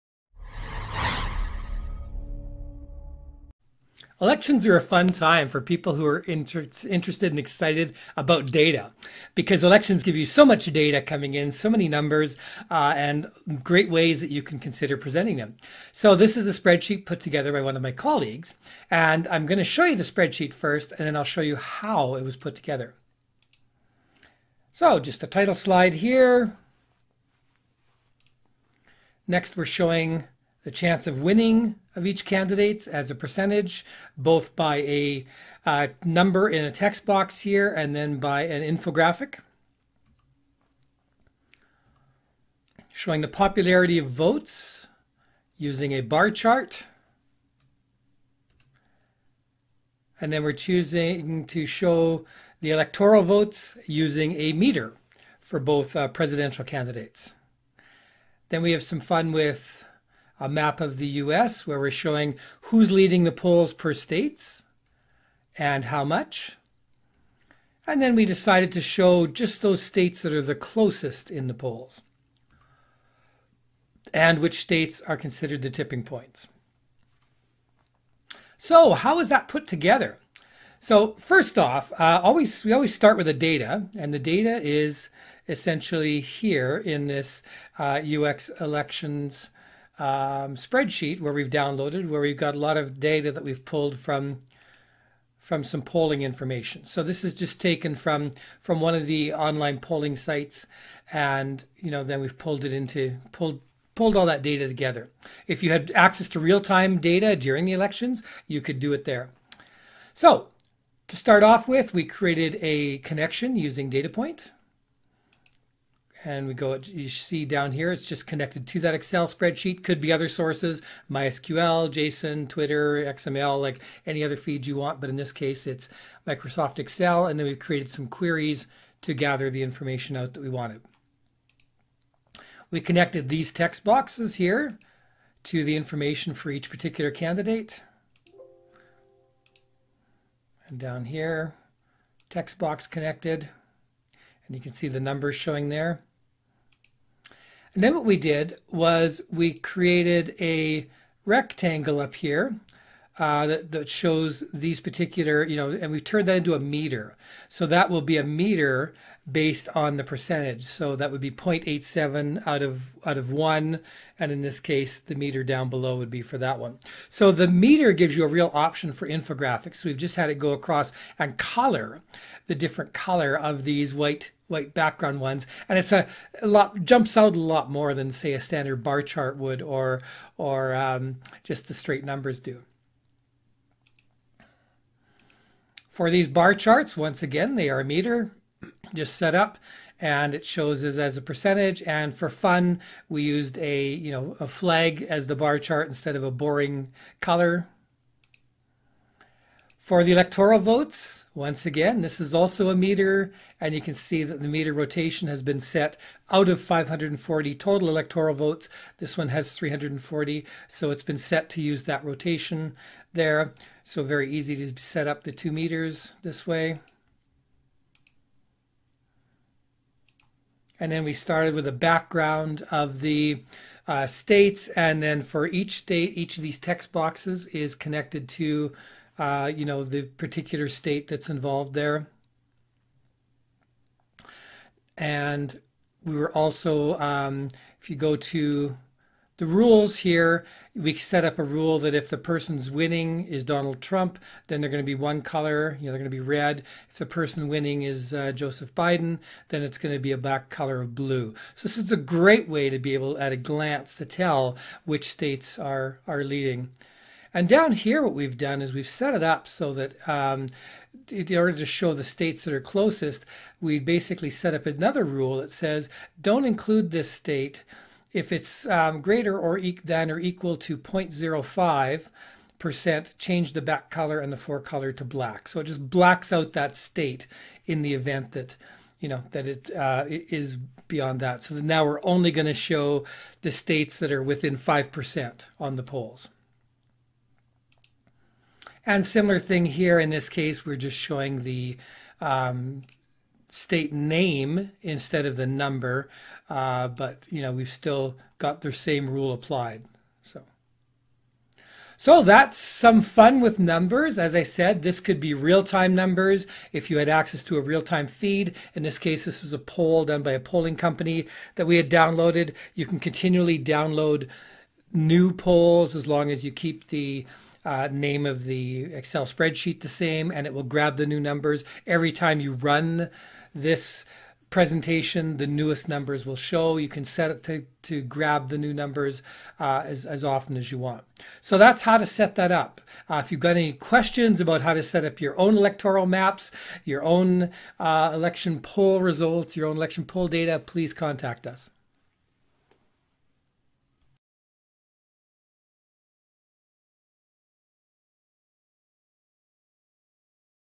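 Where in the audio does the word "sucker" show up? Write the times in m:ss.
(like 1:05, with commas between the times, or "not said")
not said.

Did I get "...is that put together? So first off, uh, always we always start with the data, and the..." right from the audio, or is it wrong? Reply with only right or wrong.
right.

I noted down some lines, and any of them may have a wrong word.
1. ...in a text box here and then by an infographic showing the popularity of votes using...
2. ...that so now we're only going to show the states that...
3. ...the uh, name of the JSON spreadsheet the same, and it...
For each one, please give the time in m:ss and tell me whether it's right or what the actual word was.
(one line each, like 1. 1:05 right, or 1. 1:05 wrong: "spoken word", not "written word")
1. 0:36 right
2. 4:41 right
3. 5:16 wrong: "Excel", not "JSON".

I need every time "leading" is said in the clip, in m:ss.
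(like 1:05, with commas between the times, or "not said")
1:02, 4:16.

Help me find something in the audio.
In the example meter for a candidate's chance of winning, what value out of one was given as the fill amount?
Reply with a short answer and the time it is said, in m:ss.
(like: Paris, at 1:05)
0.87, at 2:41.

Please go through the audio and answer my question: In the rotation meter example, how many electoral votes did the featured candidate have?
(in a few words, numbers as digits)
340.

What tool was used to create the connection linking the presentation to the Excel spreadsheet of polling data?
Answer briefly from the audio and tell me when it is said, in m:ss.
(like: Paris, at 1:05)
DataPoint, at 1:53.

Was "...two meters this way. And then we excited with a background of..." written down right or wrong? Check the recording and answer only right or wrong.
wrong.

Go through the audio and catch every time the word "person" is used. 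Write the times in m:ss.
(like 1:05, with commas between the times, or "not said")
4:02, 4:07.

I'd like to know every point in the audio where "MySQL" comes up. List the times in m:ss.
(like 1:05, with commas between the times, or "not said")
2:01.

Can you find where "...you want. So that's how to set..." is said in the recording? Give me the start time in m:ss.
5:30.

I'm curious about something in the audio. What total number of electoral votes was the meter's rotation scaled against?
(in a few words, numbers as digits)
540.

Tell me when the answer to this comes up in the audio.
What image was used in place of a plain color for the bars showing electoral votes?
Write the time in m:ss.
3:14.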